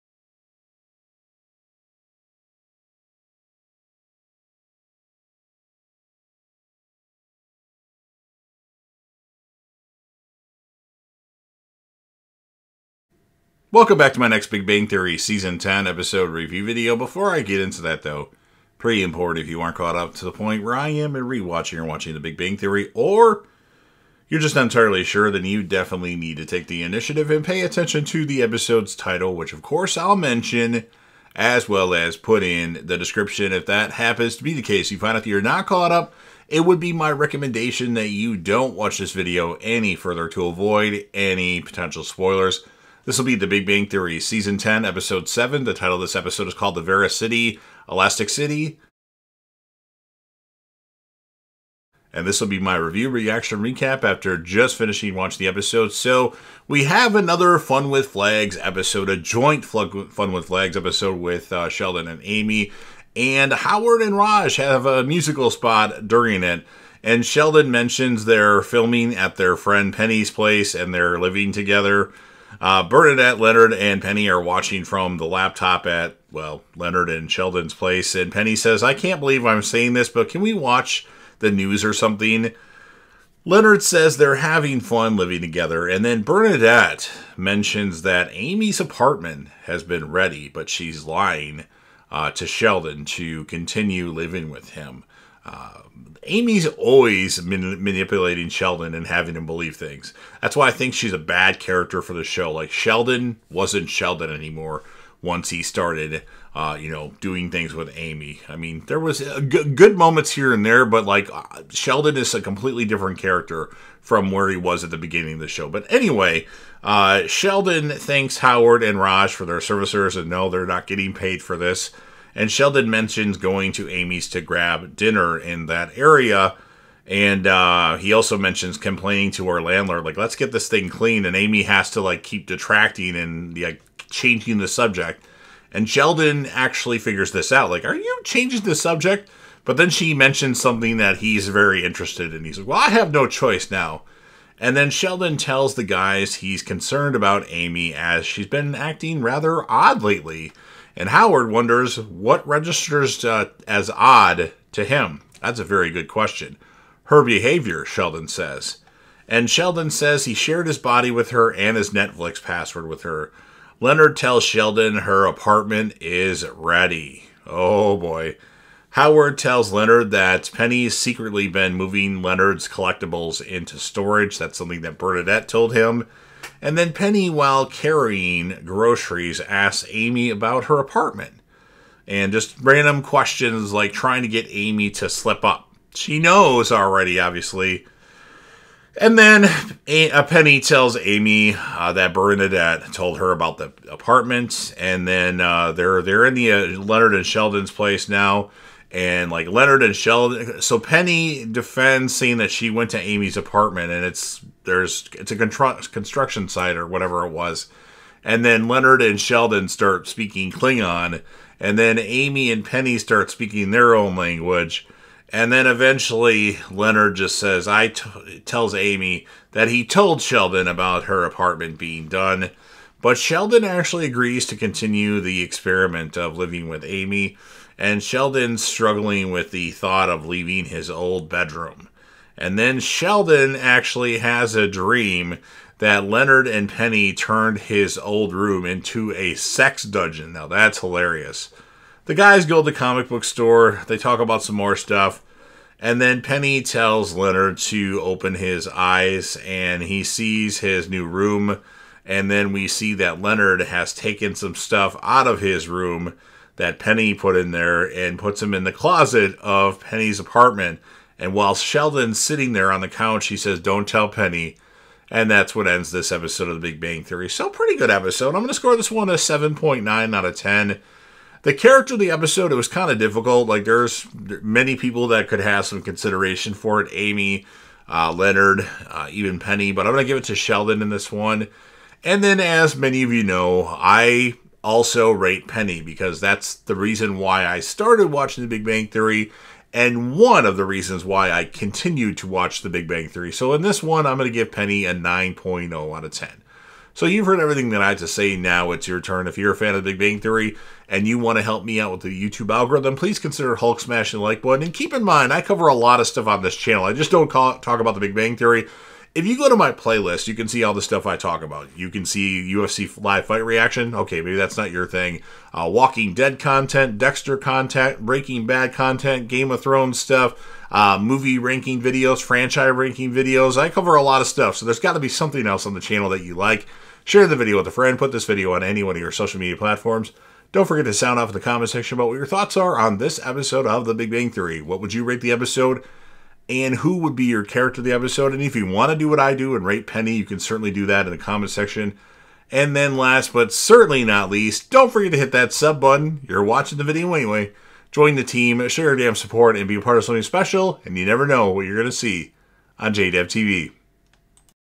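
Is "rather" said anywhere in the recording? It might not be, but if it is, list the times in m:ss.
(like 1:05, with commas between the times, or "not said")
2:29.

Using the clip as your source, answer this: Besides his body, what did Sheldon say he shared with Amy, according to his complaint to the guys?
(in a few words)
Netflix password.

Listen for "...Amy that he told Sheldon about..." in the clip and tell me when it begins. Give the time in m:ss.
3:38.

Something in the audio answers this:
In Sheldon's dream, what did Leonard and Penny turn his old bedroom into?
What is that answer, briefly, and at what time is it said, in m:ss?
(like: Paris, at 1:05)
A sex dungeon, at 3:59.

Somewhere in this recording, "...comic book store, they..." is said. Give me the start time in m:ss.
4:02.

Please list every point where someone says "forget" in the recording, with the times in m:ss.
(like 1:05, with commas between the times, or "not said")
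5:30, 5:44.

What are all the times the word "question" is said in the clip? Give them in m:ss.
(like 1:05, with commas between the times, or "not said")
2:36, 3:03.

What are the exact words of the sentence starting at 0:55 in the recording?
So we have another Fun with Flags episode, a joint Fun with Flags episode with uh, Sheldon and Amy.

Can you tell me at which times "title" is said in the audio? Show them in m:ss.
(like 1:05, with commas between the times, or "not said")
0:28, 0:45.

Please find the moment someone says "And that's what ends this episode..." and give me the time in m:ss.
4:25.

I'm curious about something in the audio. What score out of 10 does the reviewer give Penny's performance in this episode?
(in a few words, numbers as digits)
9.0.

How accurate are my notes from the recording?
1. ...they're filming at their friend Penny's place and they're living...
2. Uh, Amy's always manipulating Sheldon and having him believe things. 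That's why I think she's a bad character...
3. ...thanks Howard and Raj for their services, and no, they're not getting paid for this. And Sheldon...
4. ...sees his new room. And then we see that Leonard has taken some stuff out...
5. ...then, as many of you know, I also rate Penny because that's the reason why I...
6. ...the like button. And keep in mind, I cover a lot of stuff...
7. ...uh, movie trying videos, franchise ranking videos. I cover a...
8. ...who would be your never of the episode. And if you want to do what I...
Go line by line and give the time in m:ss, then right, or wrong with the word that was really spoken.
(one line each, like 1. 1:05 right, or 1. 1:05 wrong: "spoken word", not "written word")
1. 1:08 right
2. 1:35 right
3. 1:57 right
4. 4:10 right
5. 4:42 right
6. 5:04 right
7. 5:20 wrong: "ranking", not "trying"
8. 5:36 wrong: "character", not "never".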